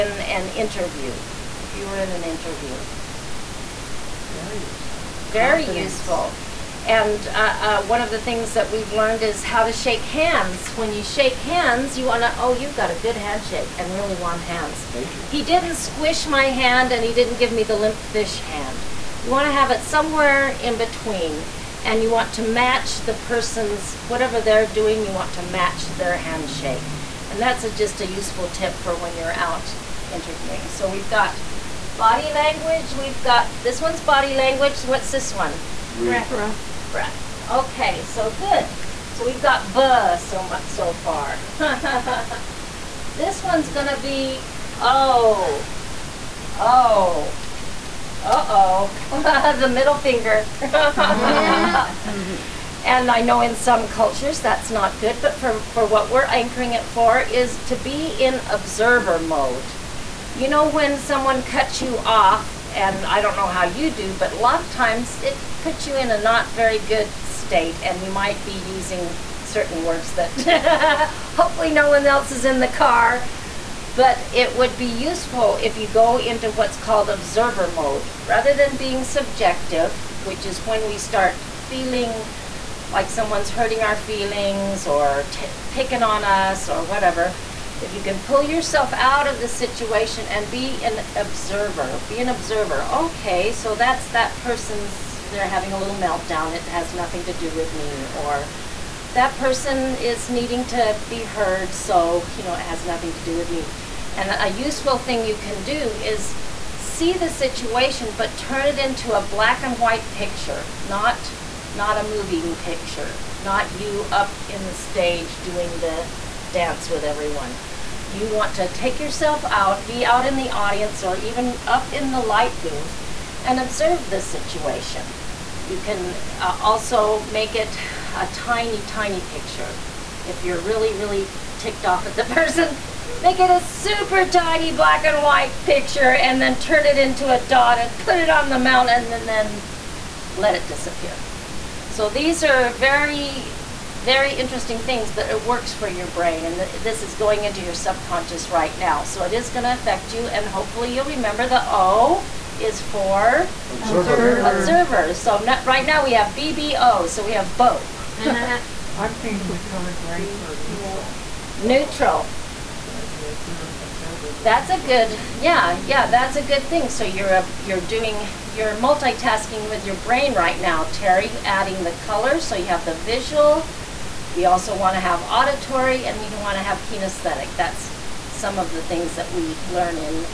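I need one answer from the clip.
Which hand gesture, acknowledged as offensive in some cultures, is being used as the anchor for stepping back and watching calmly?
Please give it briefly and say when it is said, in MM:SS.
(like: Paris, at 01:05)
the middle finger, at 00:49.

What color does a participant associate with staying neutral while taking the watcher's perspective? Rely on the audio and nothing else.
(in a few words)
gray.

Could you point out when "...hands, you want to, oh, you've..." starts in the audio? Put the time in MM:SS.
00:11.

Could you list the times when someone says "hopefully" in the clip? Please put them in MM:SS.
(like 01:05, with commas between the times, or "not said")
01:11, 02:30.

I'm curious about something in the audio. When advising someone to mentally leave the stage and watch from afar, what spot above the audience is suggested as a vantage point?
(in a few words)
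the light booth.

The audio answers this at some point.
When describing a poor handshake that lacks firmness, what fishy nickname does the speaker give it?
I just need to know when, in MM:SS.
00:17.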